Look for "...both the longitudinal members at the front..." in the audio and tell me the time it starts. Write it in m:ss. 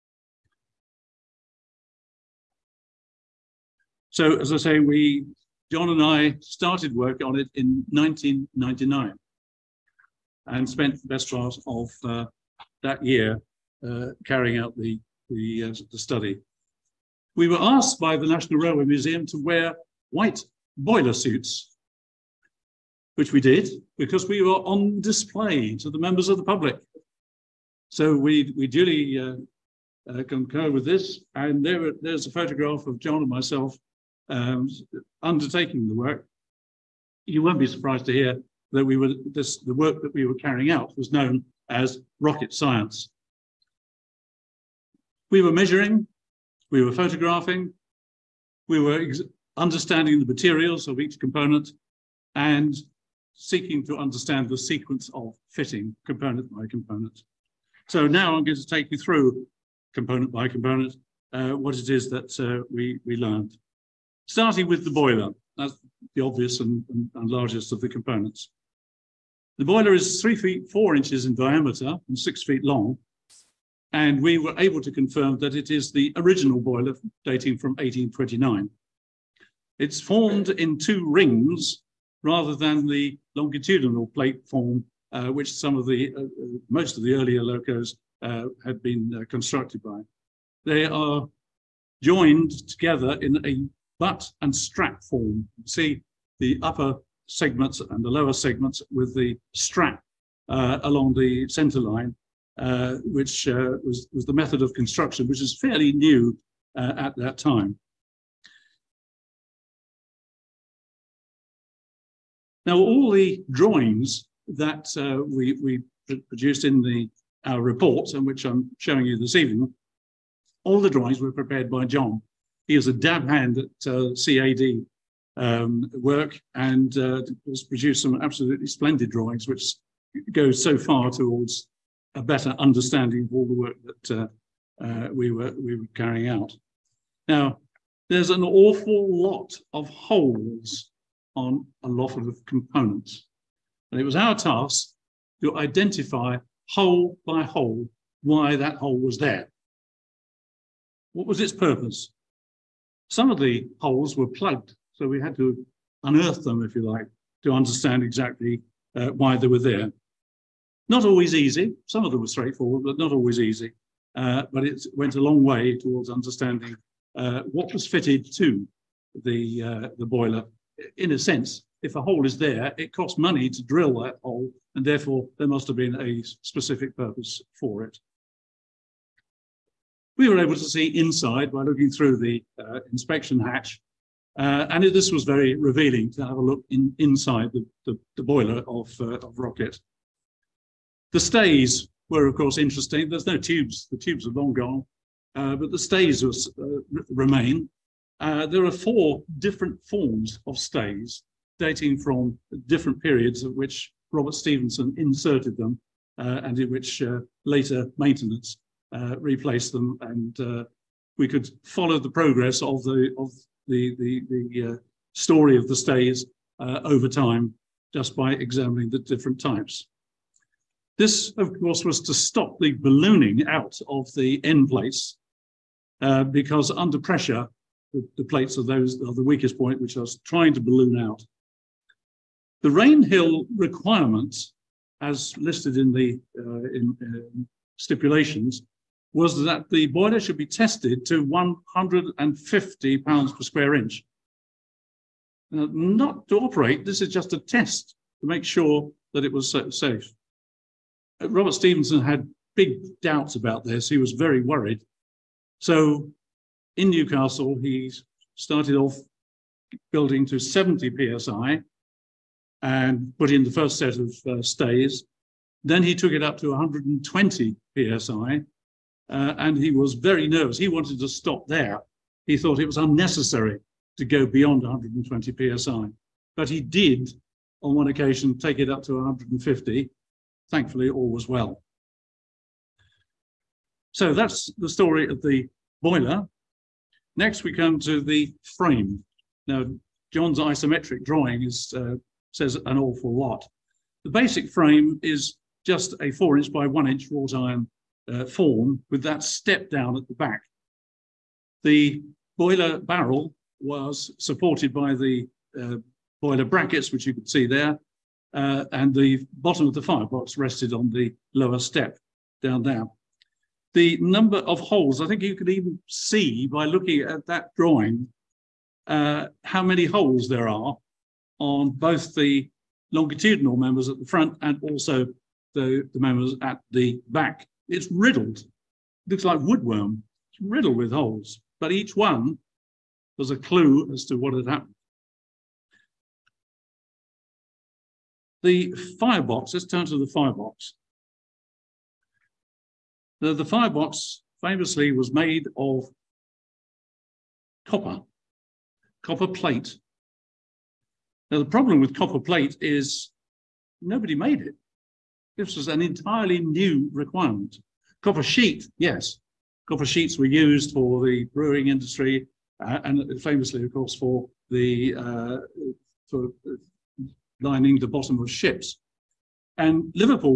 5:21.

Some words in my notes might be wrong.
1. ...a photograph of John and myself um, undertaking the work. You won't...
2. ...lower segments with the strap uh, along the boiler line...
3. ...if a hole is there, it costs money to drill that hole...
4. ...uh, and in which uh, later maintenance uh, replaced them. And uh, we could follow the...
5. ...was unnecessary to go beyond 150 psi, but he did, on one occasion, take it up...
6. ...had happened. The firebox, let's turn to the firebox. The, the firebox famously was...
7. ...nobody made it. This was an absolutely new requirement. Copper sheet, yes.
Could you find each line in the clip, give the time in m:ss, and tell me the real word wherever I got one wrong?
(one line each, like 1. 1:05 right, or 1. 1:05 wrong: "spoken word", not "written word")
1. 0:32 right
2. 1:38 wrong: "center", not "boiler"
3. 2:51 right
4. 3:26 right
5. 4:32 wrong: "120", not "150"
6. 5:34 right
7. 5:53 wrong: "entirely", not "absolutely".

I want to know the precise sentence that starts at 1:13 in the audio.
And we were able to confirm that it is the original boiler dating from 1829.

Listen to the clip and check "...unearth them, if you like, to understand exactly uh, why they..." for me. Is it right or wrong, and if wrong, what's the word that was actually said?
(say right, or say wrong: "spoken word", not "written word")
right.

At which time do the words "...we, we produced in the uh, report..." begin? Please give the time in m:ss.
1:55.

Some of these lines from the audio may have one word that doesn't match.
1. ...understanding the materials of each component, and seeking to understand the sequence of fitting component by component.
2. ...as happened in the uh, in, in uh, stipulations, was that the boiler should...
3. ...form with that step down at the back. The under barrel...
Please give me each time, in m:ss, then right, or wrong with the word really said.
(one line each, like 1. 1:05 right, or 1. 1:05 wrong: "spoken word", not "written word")
1. 0:49 right
2. 3:55 wrong: "listed", not "happened"
3. 4:58 wrong: "boiler", not "under".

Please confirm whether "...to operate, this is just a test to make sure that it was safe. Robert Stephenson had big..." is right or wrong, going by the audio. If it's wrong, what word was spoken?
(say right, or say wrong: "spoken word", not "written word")
right.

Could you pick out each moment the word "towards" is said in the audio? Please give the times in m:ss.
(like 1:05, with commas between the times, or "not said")
2:11, 2:45.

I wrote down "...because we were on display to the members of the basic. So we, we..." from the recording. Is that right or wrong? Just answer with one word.
wrong.